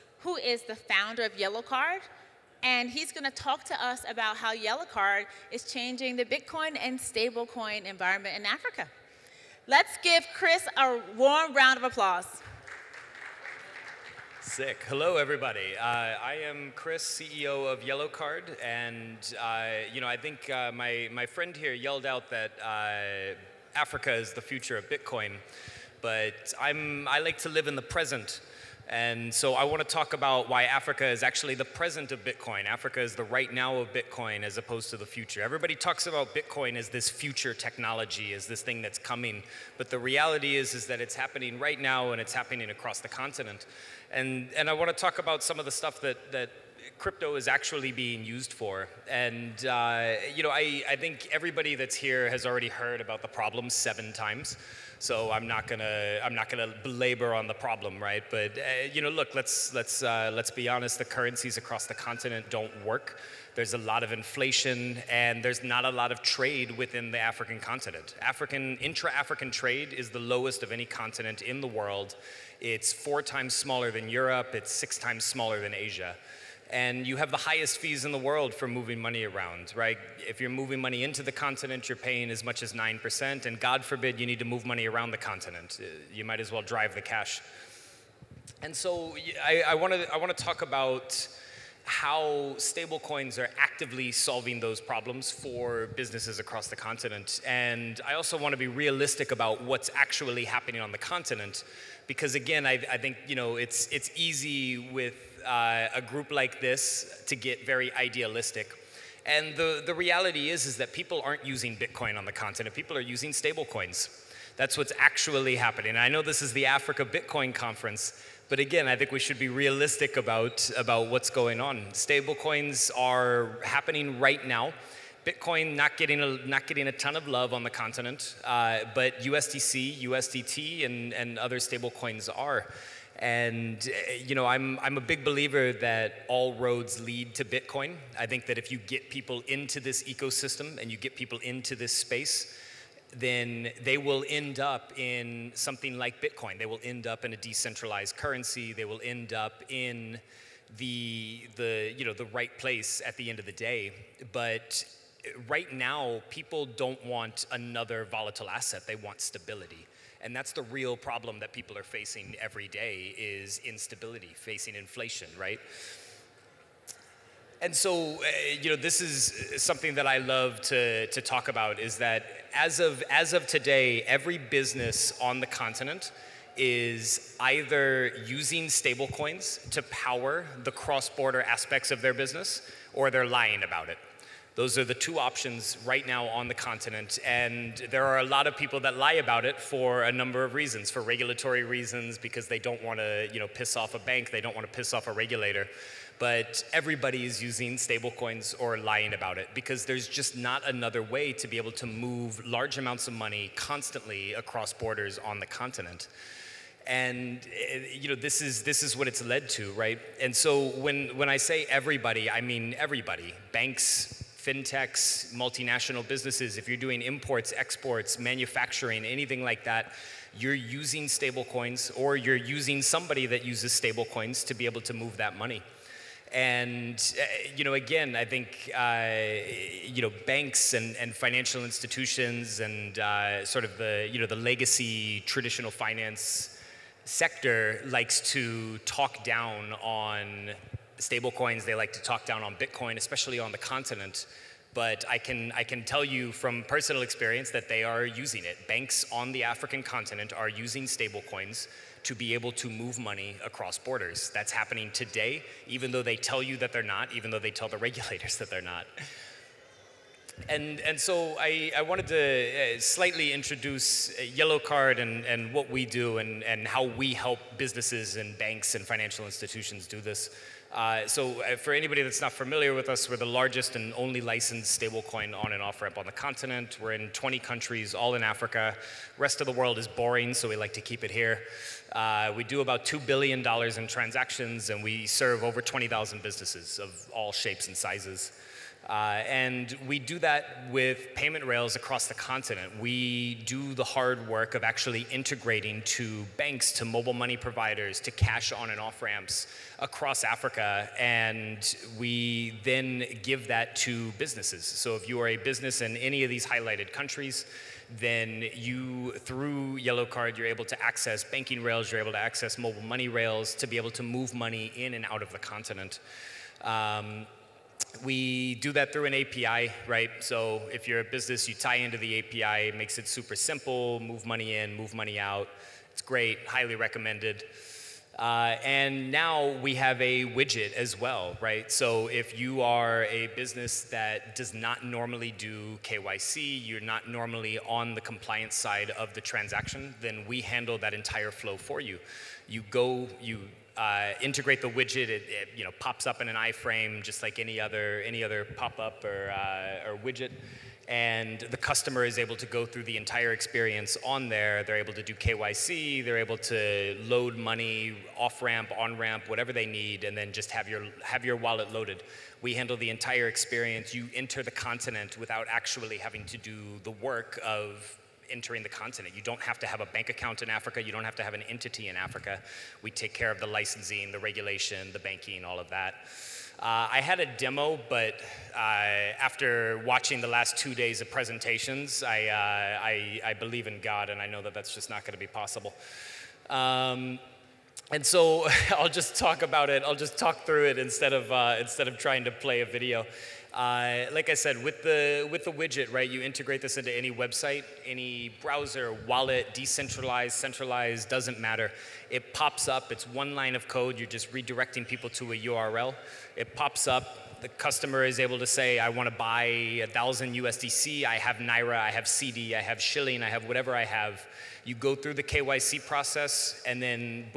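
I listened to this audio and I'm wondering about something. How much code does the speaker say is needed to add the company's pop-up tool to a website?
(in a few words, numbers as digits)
one line.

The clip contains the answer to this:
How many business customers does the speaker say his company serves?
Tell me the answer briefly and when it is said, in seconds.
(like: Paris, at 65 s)
over 20,000, at 285 s.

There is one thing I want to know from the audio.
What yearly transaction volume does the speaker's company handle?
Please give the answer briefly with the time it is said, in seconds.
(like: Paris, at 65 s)
$2 billion, at 282 s.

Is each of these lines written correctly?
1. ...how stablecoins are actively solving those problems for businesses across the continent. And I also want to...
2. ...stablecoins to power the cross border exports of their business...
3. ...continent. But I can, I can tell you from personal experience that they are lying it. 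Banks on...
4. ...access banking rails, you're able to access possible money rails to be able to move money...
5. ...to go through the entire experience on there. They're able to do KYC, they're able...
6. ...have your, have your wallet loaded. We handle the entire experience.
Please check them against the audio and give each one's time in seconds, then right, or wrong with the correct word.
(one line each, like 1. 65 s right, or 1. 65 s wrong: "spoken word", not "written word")
1. 91 s right
2. 178 s wrong: "aspects", not "exports"
3. 243 s wrong: "using", not "lying"
4. 310 s wrong: "mobile", not "possible"
5. 352 s right
6. 360 s right.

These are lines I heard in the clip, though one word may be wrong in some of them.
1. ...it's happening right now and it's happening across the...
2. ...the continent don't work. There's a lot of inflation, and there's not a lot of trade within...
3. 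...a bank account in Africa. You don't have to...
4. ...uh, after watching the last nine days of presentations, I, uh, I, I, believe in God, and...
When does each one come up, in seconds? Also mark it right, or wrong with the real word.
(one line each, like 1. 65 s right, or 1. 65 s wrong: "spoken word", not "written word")
1. 41 s right
2. 61 s right
3. 369 s right
4. 378 s wrong: "two", not "nine".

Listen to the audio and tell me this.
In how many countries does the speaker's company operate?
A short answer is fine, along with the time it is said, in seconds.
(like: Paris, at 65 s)
20, at 277 s.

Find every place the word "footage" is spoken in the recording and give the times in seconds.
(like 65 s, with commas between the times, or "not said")
not said.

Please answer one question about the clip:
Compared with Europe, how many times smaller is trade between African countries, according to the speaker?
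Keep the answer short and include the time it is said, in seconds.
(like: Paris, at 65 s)
4 times, at 72 s.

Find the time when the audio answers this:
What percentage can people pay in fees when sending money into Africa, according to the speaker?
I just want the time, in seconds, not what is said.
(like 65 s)
82 s.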